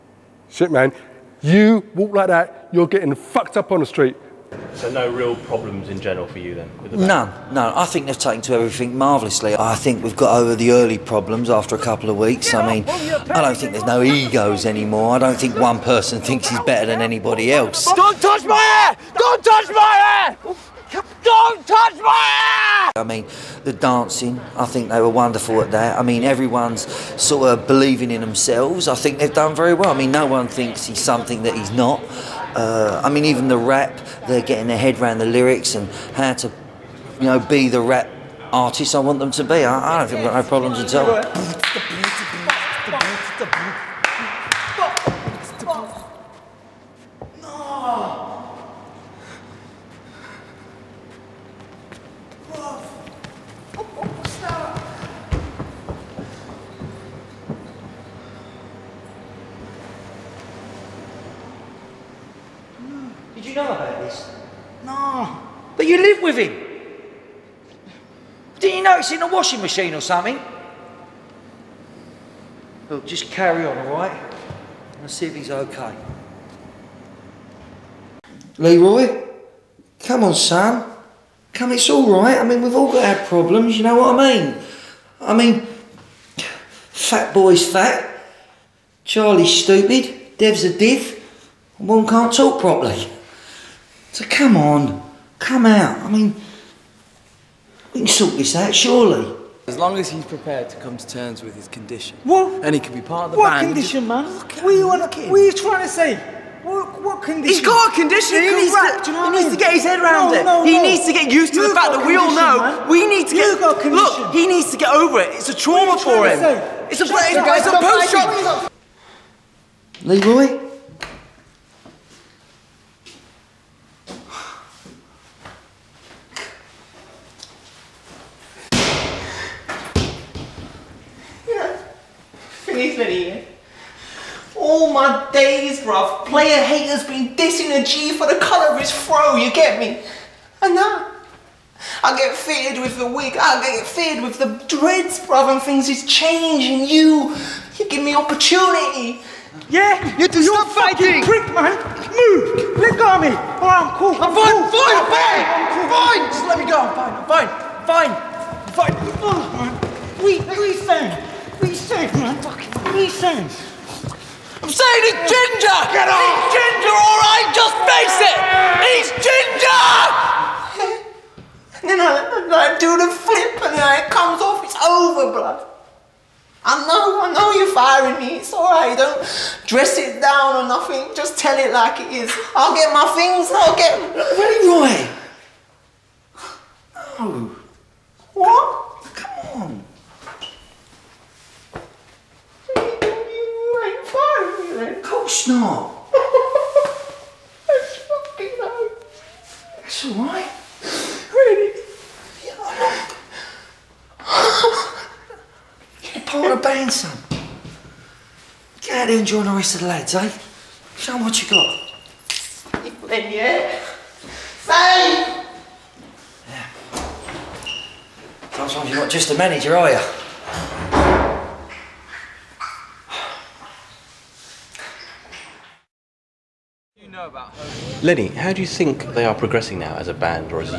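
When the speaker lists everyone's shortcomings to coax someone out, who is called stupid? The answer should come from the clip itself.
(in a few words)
Charlie.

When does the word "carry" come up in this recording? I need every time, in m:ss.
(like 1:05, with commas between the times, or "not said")
1:13.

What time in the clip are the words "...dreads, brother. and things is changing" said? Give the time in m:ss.
2:24.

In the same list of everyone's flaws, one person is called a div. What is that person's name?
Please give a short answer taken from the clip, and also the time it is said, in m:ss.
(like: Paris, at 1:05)
Dev, at 1:30.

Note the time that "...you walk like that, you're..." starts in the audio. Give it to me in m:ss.
0:01.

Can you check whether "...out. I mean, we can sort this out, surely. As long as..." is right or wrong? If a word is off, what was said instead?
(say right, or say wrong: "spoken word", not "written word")
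right.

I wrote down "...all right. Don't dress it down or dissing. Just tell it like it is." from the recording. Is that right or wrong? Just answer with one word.
wrong.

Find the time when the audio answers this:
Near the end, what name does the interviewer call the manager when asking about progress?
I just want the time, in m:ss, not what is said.
3:48.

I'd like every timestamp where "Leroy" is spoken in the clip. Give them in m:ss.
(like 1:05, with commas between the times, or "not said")
1:18, 2:00.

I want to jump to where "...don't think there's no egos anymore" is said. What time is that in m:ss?
0:13.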